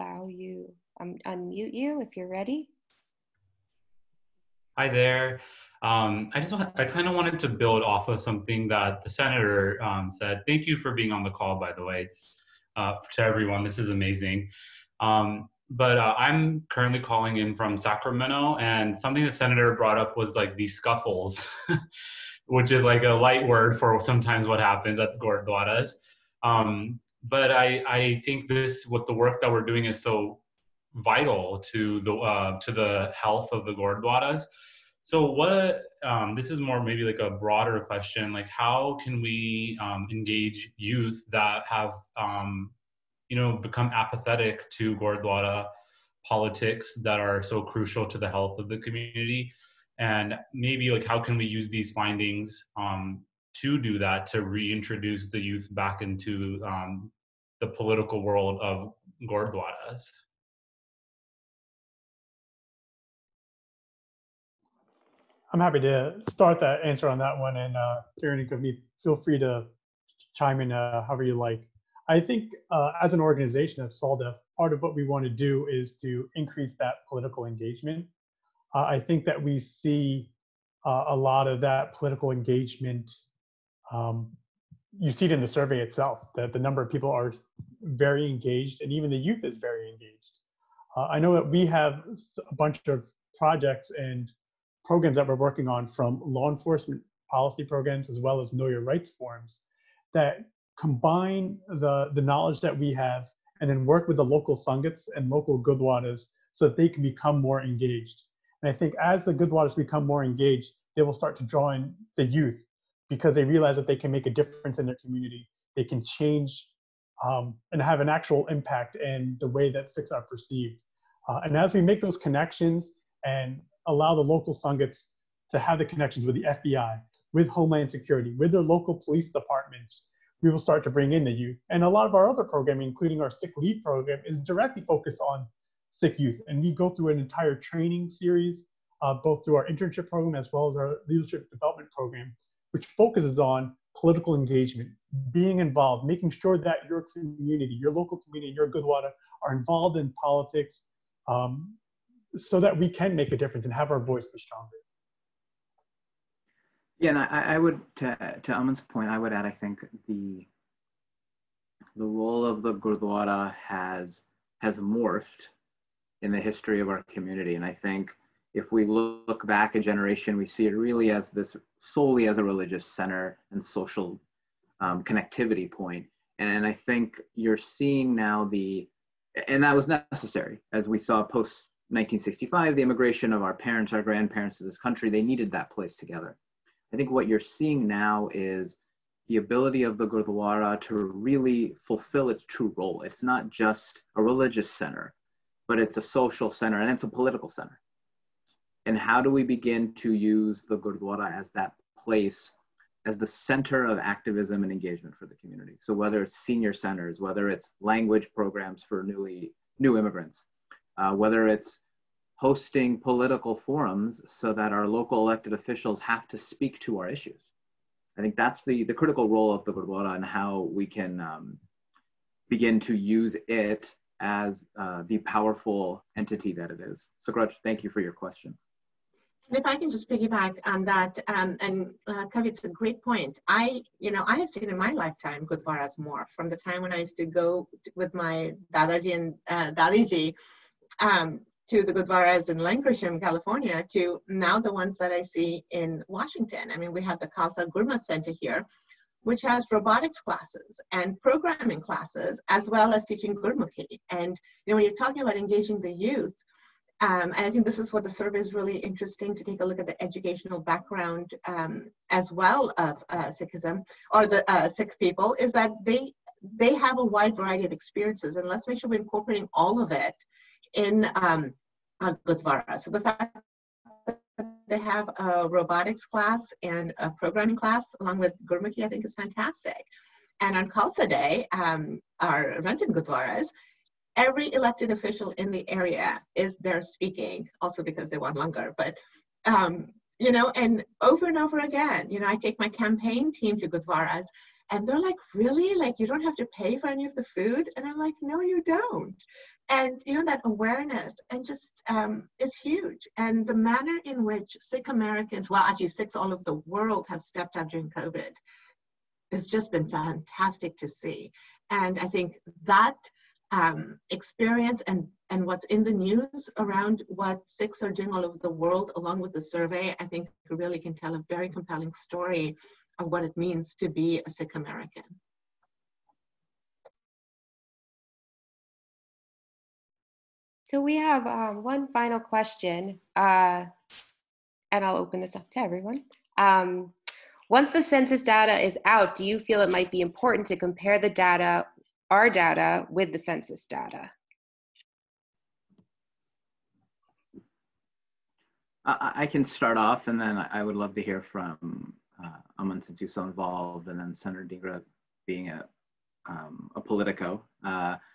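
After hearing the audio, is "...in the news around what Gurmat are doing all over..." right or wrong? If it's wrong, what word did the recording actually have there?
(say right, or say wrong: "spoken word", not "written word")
wrong: "Sikhs", not "Gurmat".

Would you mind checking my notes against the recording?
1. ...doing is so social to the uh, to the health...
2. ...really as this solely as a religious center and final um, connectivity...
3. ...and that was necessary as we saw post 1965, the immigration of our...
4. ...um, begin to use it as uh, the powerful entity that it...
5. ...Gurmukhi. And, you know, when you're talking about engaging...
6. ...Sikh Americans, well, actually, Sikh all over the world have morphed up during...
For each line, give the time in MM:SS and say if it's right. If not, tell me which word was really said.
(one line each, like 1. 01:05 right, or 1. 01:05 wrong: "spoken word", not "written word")
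1. 00:29 wrong: "vital", not "social"
2. 02:50 wrong: "social", not "final"
3. 02:59 right
4. 03:41 right
5. 04:13 right
6. 05:04 wrong: "stepped", not "morphed".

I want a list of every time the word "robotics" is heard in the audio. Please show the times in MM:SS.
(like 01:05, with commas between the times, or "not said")
04:09, 04:35.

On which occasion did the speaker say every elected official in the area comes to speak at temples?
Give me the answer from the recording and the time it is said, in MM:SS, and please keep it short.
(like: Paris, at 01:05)
Khalsa Day, at 04:40.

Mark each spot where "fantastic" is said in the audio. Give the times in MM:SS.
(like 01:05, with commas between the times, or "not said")
04:39, 05:09.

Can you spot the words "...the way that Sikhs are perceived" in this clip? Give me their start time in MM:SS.
01:59.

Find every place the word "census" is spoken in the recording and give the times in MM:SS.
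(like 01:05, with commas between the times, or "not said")
05:37, 05:43.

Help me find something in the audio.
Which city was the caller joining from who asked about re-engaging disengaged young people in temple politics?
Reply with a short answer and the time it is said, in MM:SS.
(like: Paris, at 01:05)
Sacramento, at 00:17.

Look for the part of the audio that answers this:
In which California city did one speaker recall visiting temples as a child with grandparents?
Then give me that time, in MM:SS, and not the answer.
04:02.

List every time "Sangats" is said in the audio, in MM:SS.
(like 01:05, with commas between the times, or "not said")
01:44, 02:04.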